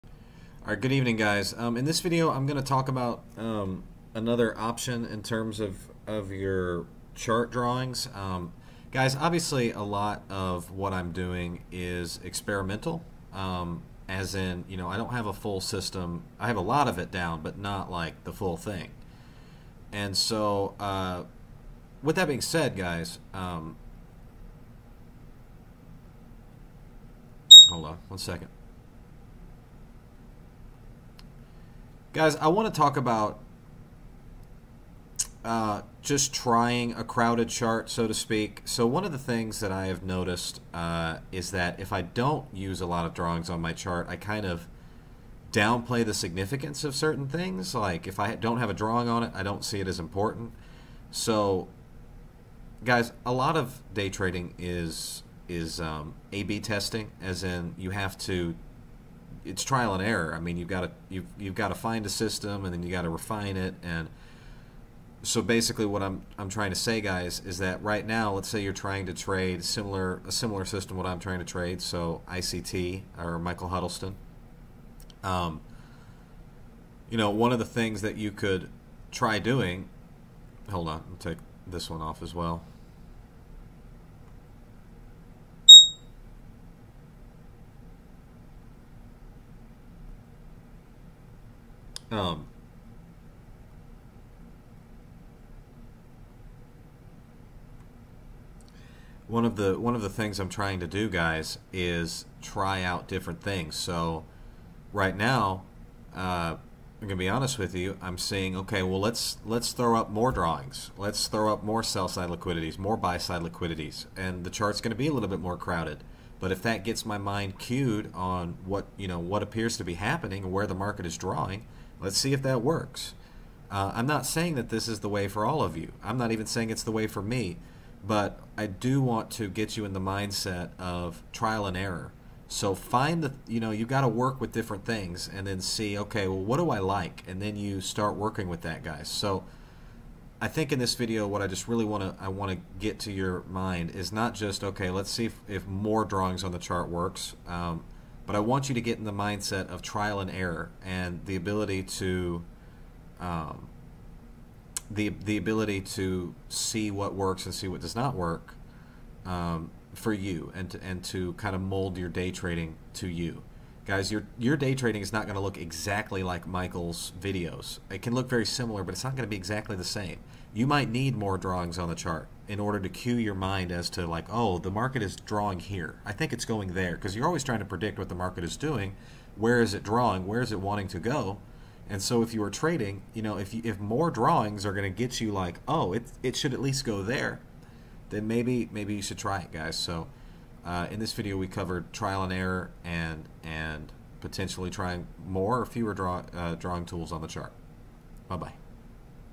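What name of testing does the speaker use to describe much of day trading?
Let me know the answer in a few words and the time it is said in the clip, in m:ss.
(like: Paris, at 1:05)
A/B testing, at 0:56.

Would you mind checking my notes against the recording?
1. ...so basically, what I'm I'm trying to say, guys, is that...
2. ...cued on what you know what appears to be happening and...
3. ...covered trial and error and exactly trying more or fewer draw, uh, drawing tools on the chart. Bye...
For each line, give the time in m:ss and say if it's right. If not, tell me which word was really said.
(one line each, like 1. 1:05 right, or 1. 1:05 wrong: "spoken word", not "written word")
1. 1:05 right
2. 1:57 right
3. 3:11 wrong: "potentially", not "exactly".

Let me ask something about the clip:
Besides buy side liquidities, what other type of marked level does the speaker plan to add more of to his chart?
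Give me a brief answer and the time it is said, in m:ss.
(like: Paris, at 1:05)
Sell side liquidities, at 1:51.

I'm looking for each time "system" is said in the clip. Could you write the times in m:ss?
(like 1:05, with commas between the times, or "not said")
0:15, 1:02, 1:10.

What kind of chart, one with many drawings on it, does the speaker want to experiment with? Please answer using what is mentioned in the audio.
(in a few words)
A crowded chart.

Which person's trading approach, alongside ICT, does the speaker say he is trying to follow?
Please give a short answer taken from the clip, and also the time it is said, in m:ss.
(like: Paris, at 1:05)
Michael Huddleston, at 1:13.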